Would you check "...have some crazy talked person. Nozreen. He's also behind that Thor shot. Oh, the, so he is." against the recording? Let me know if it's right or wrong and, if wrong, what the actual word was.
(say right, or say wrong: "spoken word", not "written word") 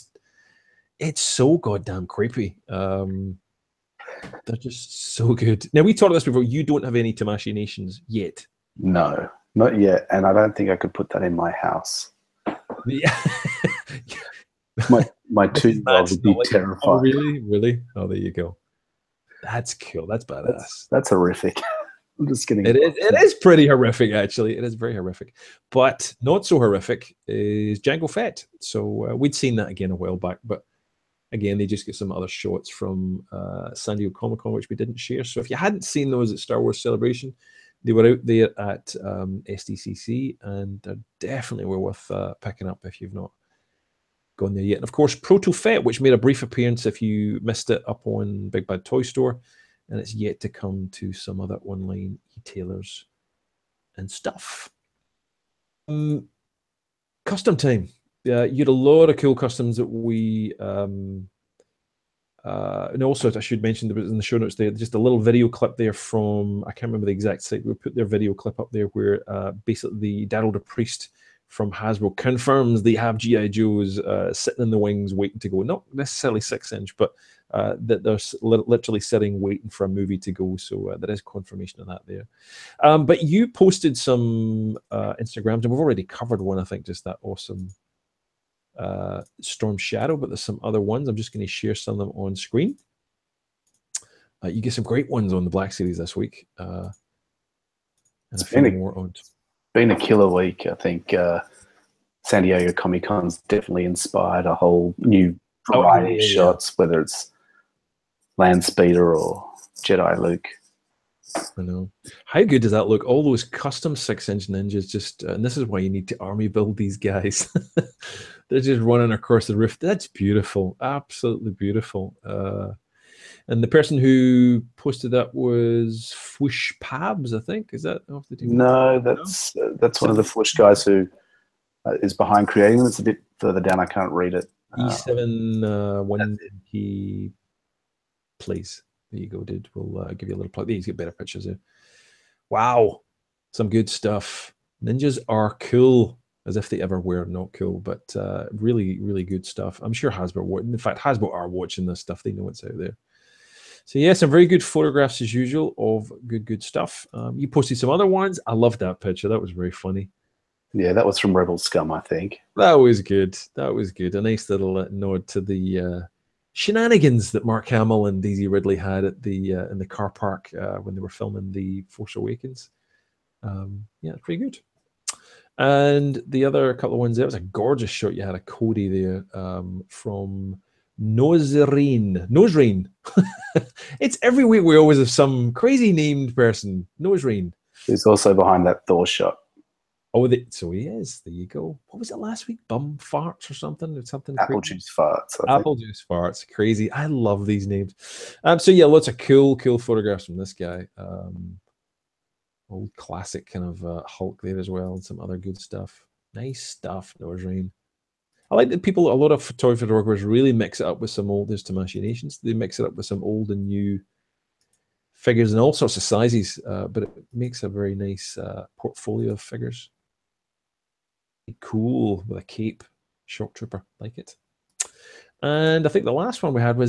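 wrong: "named", not "talked".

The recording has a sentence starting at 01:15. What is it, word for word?
Not necessarily six inch, but uh, that they're literally sitting waiting for a movie to go.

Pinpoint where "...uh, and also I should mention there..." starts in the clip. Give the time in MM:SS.
01:02.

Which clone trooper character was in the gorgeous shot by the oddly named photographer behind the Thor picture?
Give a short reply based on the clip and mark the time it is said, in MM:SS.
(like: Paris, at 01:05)
Cody, at 02:58.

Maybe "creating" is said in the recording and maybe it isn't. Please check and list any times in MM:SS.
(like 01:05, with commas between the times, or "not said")
02:12.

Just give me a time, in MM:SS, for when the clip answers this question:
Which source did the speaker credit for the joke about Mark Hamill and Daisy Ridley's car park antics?
02:41.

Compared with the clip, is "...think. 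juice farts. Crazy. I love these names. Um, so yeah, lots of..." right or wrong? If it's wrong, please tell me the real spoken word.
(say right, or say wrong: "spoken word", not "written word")
right.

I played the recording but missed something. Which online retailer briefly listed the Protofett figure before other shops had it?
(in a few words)
Big Bad Toy Store.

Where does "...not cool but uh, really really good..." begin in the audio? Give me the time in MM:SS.
02:27.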